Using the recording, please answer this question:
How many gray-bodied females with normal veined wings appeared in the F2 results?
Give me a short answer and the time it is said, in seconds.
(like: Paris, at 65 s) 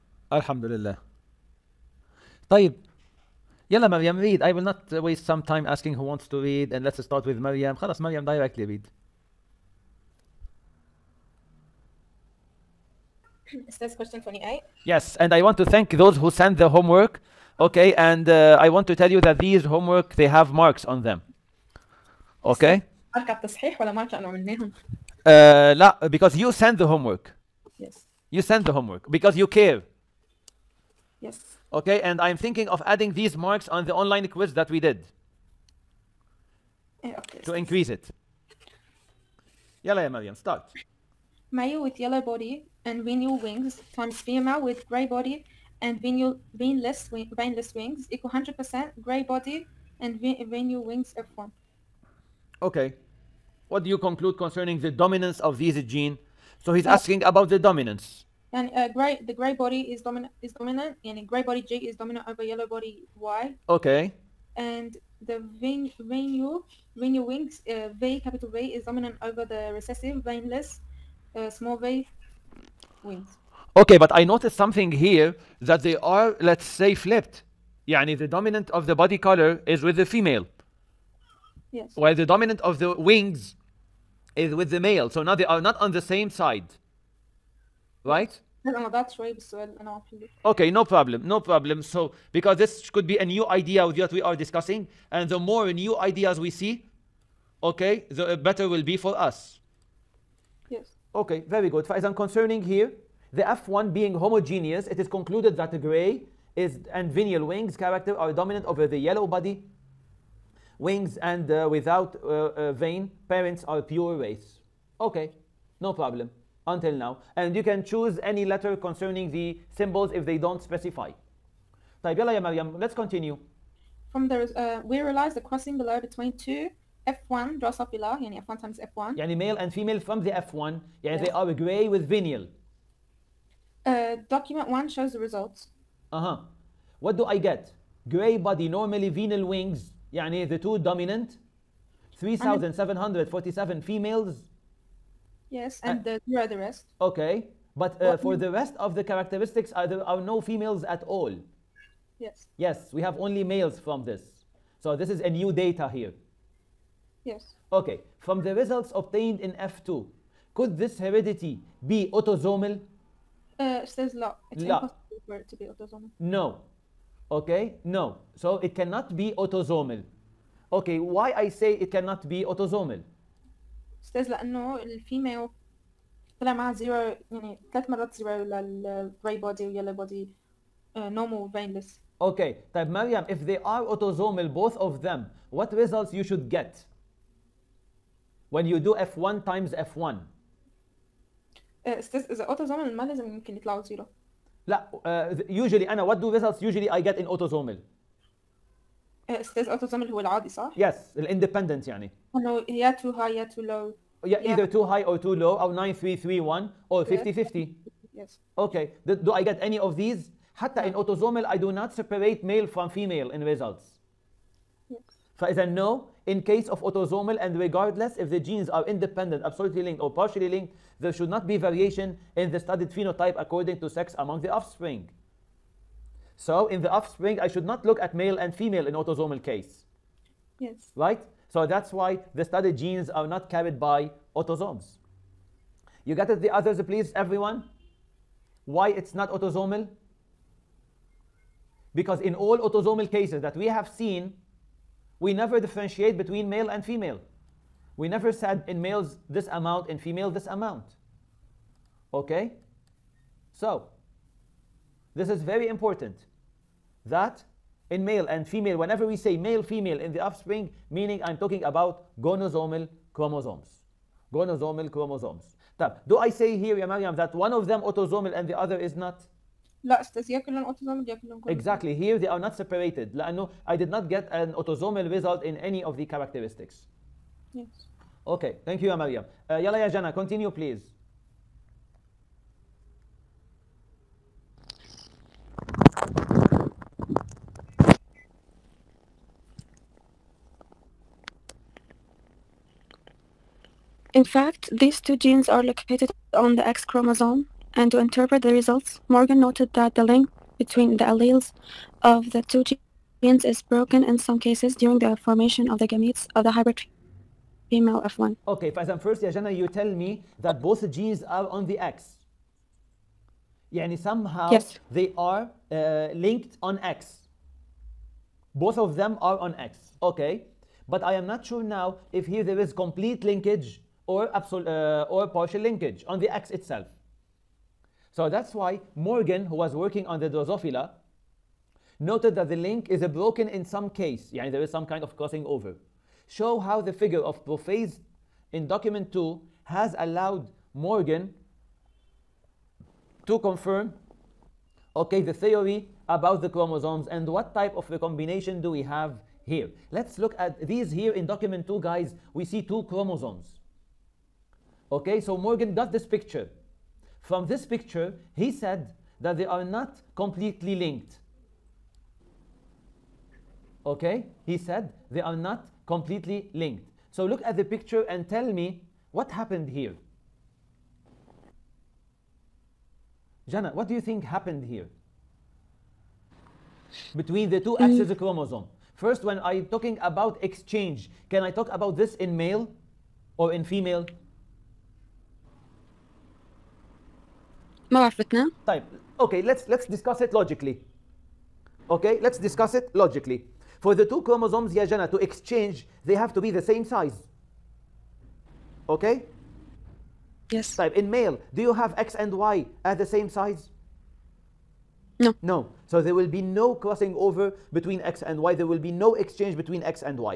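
3747, at 142 s.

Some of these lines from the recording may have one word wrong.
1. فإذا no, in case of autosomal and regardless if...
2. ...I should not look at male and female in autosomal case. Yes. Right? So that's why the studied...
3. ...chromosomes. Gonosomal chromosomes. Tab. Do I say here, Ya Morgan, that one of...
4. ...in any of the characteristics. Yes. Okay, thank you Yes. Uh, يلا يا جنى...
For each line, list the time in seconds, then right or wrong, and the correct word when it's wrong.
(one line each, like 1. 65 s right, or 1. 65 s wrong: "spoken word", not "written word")
1. 215 s right
2. 227 s right
3. 263 s wrong: "Maryam", not "Morgan"
4. 275 s wrong: "Amalia", not "Yes".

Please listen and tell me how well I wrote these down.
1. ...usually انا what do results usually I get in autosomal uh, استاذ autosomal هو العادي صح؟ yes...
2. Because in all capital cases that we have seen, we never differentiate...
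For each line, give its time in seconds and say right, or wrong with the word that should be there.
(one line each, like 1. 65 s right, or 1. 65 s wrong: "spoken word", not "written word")
1. 195 s right
2. 241 s wrong: "autosomal", not "capital".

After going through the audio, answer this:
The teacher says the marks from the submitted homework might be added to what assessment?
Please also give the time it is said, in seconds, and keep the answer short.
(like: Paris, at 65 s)
the online quiz, at 34 s.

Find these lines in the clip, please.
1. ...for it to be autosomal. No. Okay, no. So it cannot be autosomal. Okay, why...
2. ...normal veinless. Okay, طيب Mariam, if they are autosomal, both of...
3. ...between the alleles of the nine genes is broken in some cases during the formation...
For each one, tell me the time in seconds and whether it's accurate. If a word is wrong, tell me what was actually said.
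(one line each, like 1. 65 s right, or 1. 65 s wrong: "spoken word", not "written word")
1. 165 s right
2. 180 s right
3. 300 s wrong: "two", not "nine".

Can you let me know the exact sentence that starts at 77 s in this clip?
Yani the dominant of the body color is with the female.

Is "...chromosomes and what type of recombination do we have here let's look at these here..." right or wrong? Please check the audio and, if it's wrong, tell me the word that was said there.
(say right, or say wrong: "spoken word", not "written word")
right.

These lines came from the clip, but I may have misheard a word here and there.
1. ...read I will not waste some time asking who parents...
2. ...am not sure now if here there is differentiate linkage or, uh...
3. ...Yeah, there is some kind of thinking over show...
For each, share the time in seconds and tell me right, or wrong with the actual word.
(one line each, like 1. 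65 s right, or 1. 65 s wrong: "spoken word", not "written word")
1. 4 s wrong: "wants", not "parents"
2. 321 s wrong: "complete", not "differentiate"
3. 334 s wrong: "crossing", not "thinking".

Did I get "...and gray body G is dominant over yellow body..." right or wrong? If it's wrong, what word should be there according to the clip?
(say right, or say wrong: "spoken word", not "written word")
right.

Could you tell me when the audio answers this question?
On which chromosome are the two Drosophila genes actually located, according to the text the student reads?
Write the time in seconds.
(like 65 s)
296 s.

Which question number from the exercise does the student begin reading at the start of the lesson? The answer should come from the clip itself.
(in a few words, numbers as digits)
28.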